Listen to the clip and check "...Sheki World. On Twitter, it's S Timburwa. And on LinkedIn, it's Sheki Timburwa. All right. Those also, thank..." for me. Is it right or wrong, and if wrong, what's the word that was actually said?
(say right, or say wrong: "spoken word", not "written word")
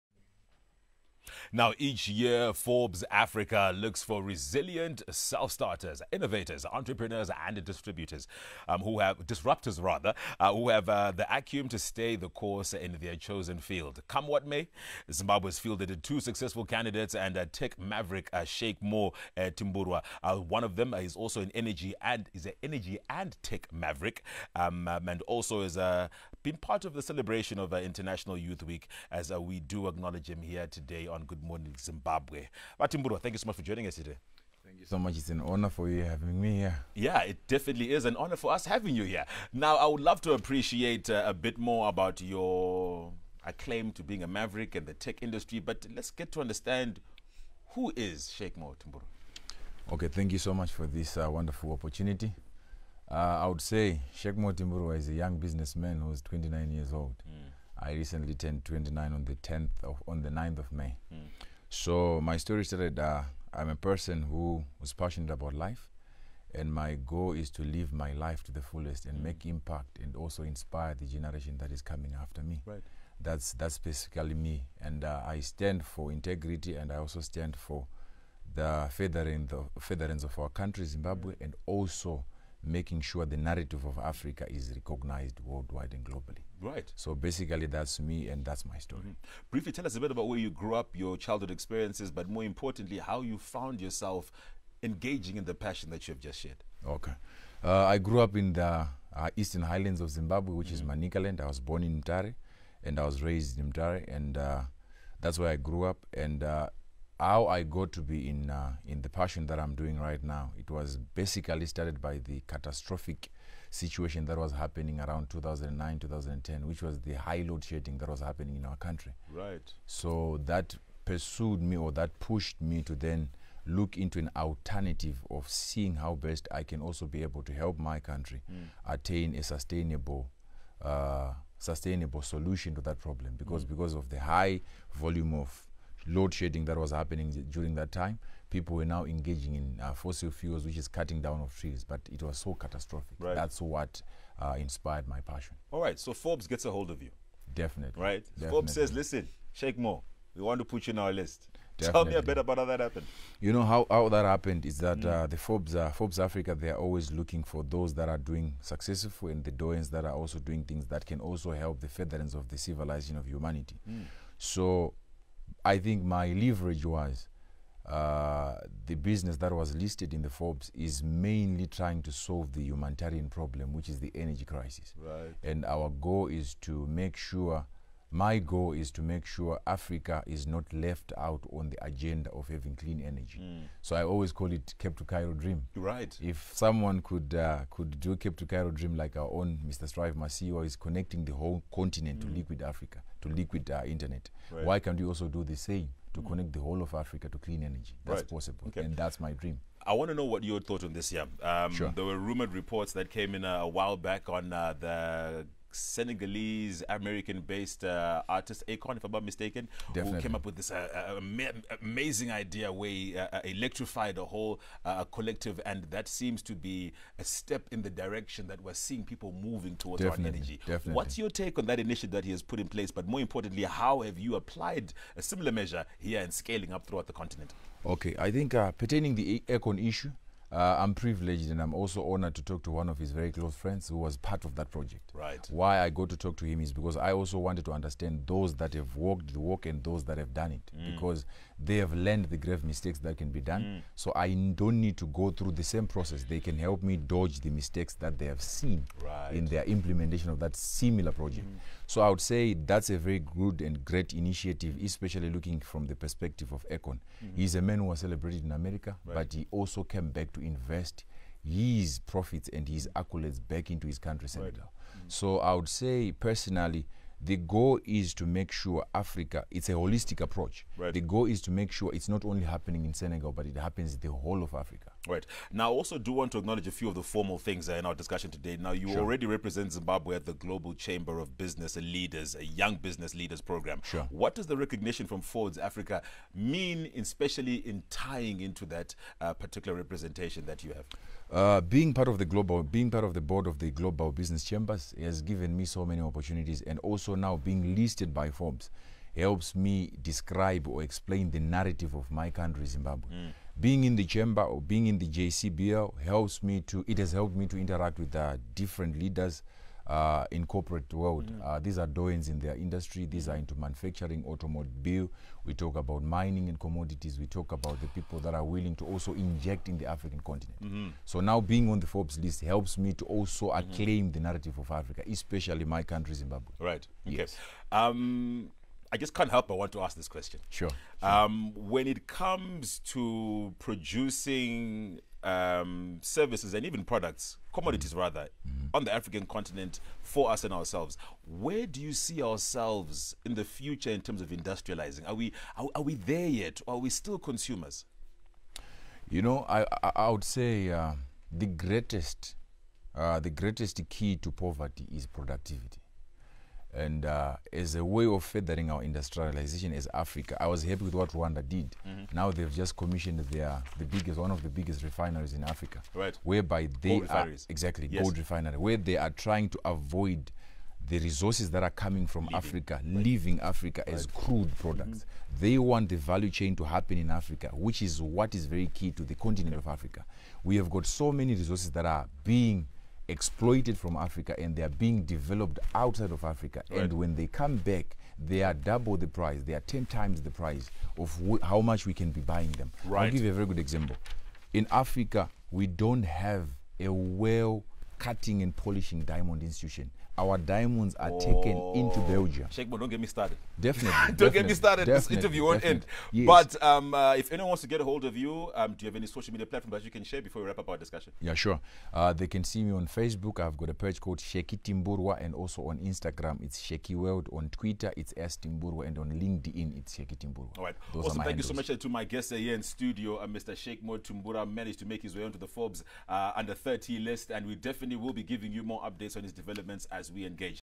right.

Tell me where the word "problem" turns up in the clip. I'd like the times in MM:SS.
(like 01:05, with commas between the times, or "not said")
02:12, 02:53.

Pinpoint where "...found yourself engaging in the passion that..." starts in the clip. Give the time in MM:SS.
01:33.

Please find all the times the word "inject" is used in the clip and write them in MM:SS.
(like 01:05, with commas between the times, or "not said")
05:19.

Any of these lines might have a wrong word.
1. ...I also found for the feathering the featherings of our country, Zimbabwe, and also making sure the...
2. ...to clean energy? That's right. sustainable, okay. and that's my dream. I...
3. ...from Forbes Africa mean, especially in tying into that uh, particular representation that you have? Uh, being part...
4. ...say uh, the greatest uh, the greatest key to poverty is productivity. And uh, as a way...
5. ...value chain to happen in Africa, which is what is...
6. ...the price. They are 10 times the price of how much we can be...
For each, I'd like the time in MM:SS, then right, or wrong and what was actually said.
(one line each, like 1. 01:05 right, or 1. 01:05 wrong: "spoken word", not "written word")
1. 01:16 wrong: "stand", not "found"
2. 03:17 wrong: "possible", not "sustainable"
3. 04:45 right
4. 05:50 right
5. 06:15 right
6. 06:28 right.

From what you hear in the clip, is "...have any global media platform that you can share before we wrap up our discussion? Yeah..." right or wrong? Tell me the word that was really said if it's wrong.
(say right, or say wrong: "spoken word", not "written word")
wrong: "social", not "global".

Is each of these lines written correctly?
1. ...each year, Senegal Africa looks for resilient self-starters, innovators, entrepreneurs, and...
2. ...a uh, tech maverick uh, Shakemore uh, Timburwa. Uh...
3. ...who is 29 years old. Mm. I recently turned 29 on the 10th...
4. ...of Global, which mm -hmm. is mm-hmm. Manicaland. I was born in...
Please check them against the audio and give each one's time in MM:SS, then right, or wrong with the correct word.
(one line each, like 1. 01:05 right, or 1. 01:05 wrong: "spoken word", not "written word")
1. 00:01 wrong: "Forbes", not "Senegal"
2. 00:17 right
3. 00:55 right
4. 01:40 wrong: "Zimbabwe", not "Global".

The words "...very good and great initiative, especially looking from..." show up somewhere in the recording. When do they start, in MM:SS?
04:12.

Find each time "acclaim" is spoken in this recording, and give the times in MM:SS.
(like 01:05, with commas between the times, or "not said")
00:43, 05:23.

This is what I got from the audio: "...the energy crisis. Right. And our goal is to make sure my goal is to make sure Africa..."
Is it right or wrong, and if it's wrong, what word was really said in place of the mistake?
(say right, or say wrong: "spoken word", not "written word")
right.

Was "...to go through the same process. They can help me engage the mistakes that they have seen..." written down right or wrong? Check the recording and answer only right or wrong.
wrong.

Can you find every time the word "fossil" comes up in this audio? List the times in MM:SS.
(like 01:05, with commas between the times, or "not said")
02:19.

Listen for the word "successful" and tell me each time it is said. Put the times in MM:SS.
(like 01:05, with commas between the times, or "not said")
00:16, 02:38.